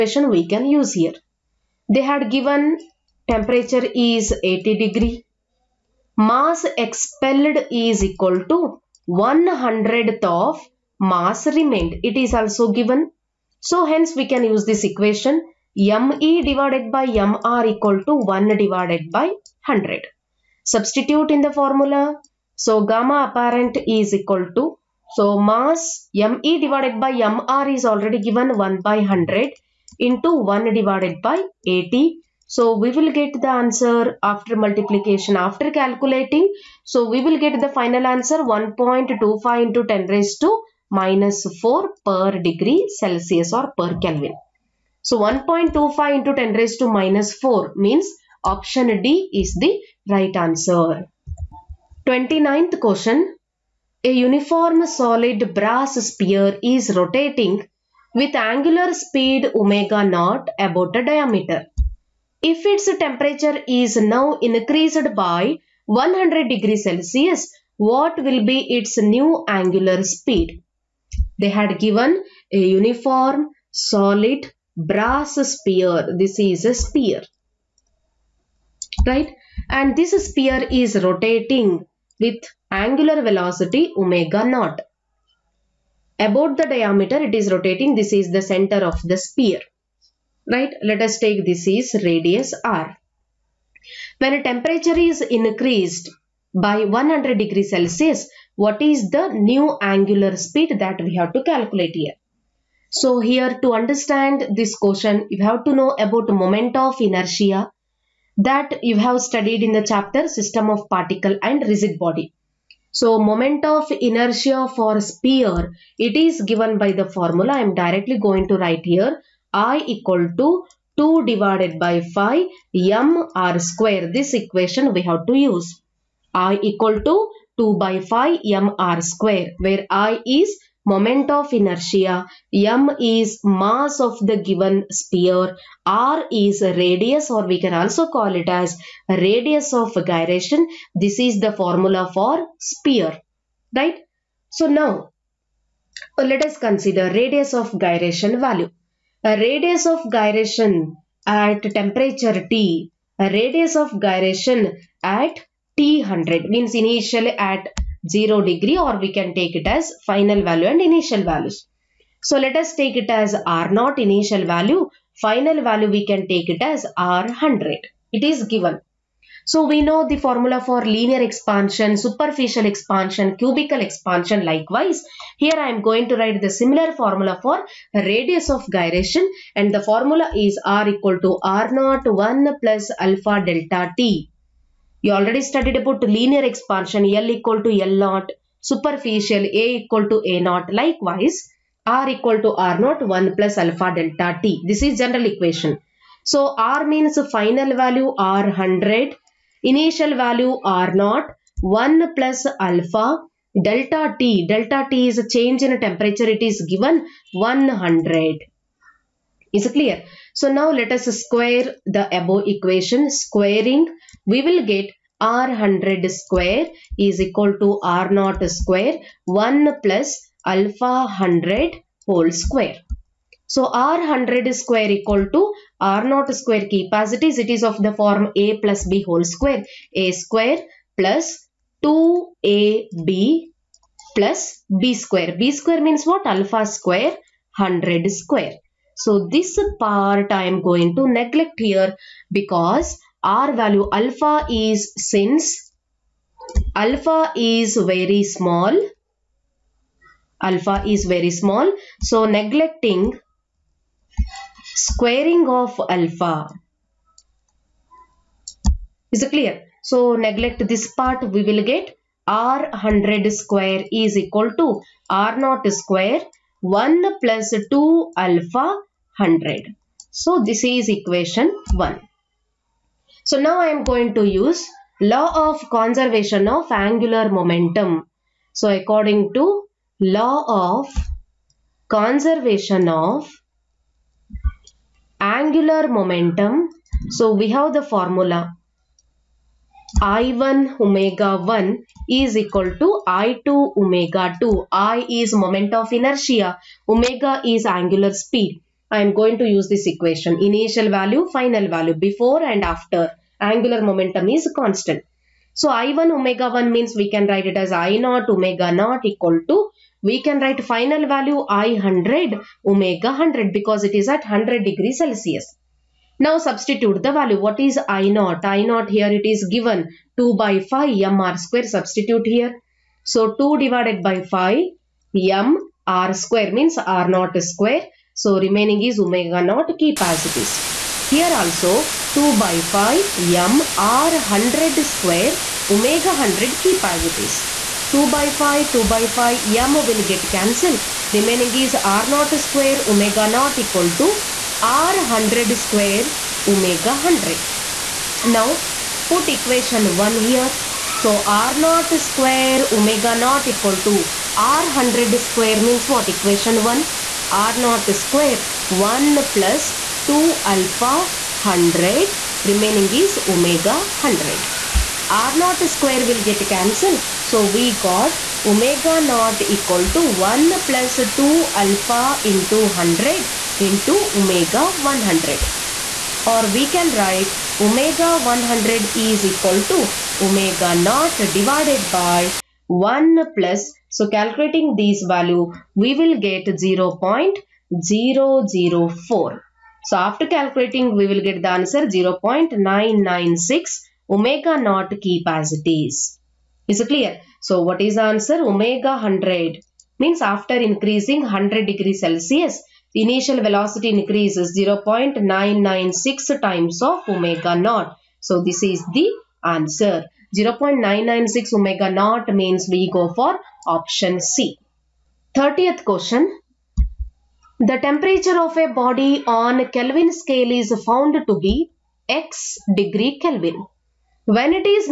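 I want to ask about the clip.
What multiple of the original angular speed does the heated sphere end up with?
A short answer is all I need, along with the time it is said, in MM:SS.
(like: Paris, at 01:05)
0.996, at 06:31.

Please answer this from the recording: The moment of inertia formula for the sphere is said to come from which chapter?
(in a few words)
System of particle and rigid body.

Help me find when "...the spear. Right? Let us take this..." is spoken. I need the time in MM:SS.
01:29.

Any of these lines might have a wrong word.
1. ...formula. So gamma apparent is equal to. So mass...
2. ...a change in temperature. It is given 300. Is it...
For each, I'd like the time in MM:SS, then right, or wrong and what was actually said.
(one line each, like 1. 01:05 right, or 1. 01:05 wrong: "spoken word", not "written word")
1. 00:21 right
2. 03:25 wrong: "100", not "300".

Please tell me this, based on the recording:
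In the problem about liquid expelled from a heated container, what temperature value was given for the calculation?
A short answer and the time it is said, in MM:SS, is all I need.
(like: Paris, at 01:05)
80 degrees, at 00:04.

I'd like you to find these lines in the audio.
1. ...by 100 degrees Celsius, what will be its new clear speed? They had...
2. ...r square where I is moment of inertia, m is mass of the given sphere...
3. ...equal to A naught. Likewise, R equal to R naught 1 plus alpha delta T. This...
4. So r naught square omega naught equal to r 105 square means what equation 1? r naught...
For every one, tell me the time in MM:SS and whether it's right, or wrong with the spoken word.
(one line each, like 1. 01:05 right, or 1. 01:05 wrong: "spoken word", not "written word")
1. 01:05 wrong: "angular", not "clear"
2. 02:08 right
3. 03:09 right
4. 05:51 wrong: "100", not "105".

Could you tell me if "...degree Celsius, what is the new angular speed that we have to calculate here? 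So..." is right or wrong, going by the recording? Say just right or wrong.
right.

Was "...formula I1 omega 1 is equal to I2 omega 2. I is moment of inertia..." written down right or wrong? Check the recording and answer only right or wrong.
right.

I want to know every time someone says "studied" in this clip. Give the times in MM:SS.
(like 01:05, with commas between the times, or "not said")
01:49, 03:05.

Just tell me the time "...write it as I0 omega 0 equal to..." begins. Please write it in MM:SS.
05:07.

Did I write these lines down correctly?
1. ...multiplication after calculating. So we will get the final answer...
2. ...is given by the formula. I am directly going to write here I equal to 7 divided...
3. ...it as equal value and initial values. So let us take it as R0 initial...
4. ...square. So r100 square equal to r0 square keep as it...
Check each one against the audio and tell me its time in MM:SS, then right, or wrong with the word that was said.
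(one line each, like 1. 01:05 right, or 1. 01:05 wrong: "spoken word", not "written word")
1. 00:34 right
2. 01:56 wrong: "2", not "7"
3. 02:39 wrong: "final", not "equal"
4. 03:42 right.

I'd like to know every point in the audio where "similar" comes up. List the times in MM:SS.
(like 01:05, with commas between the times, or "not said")
02:56.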